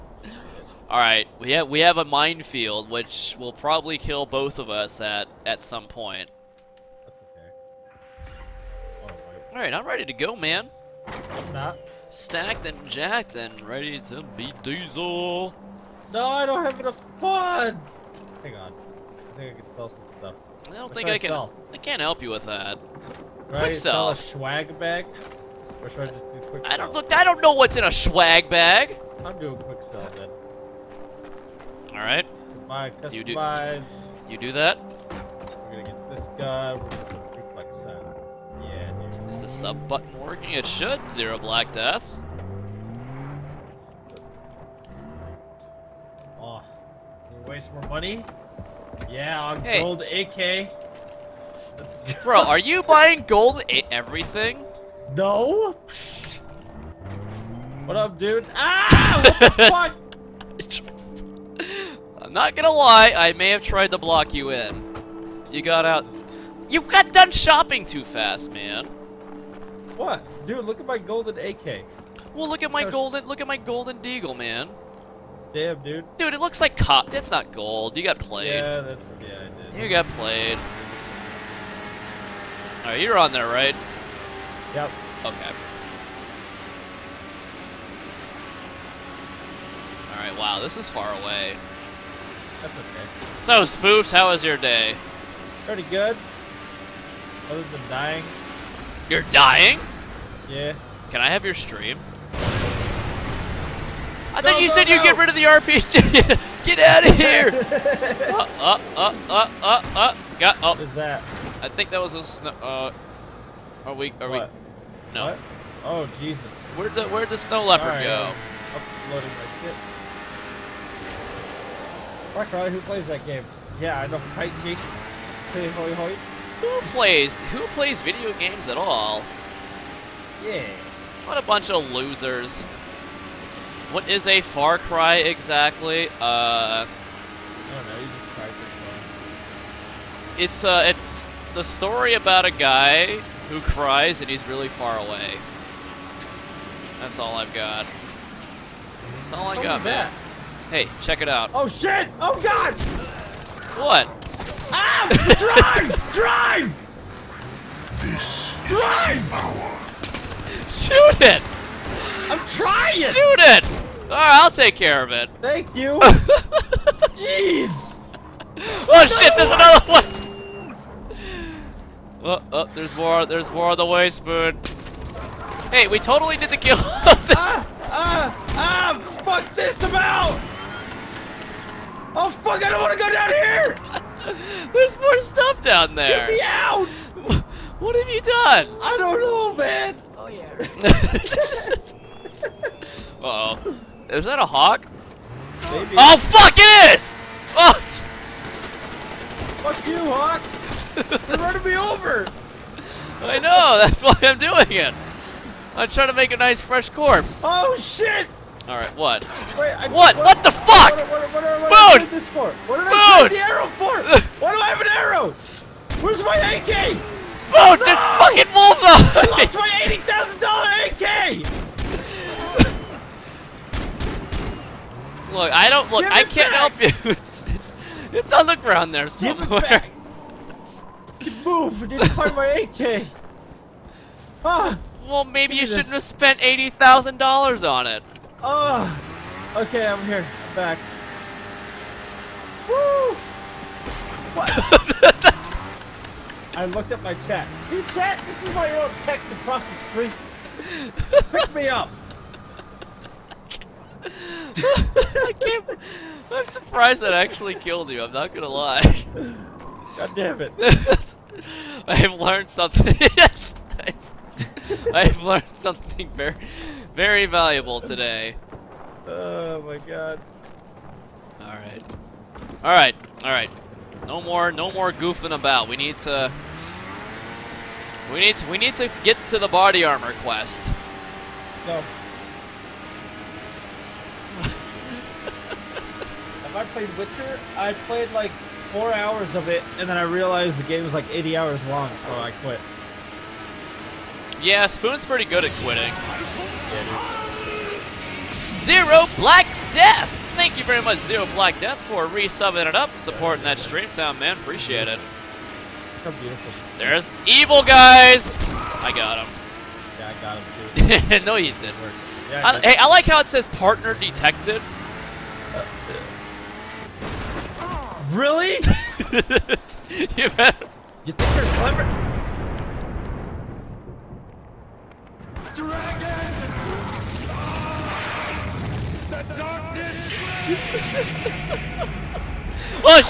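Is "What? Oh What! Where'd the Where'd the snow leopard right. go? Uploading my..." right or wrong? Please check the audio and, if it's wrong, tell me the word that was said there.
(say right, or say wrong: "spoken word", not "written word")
wrong: "Jesus", not "What".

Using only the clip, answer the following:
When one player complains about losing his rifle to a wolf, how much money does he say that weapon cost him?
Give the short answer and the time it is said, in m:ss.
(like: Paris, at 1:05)
$80,000, at 3:39.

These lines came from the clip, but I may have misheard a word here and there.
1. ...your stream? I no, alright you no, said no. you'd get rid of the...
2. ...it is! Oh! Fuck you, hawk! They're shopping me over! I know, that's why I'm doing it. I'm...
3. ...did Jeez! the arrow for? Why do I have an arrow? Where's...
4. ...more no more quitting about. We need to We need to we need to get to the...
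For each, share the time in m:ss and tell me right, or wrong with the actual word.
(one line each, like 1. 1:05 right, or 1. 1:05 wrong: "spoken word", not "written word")
1. 1:41 wrong: "thought", not "alright"
2. 3:16 wrong: "running", not "shopping"
3. 3:33 wrong: "Spoon", not "Jeez"
4. 4:34 wrong: "goofing", not "quitting".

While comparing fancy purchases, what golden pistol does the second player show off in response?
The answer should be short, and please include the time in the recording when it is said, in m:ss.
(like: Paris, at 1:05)
deagle, at 1:13.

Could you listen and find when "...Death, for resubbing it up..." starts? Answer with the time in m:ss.
5:01.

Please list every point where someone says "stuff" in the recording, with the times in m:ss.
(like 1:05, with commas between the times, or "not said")
0:20, 3:05.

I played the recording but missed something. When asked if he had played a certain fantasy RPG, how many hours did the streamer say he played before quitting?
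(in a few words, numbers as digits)
4.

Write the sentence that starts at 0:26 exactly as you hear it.
don't, look, I don't know what's in a swag bag.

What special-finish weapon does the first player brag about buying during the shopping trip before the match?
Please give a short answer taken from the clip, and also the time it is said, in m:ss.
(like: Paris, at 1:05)
gold AK, at 0:49.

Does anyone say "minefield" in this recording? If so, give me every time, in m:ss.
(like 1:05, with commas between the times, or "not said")
0:02.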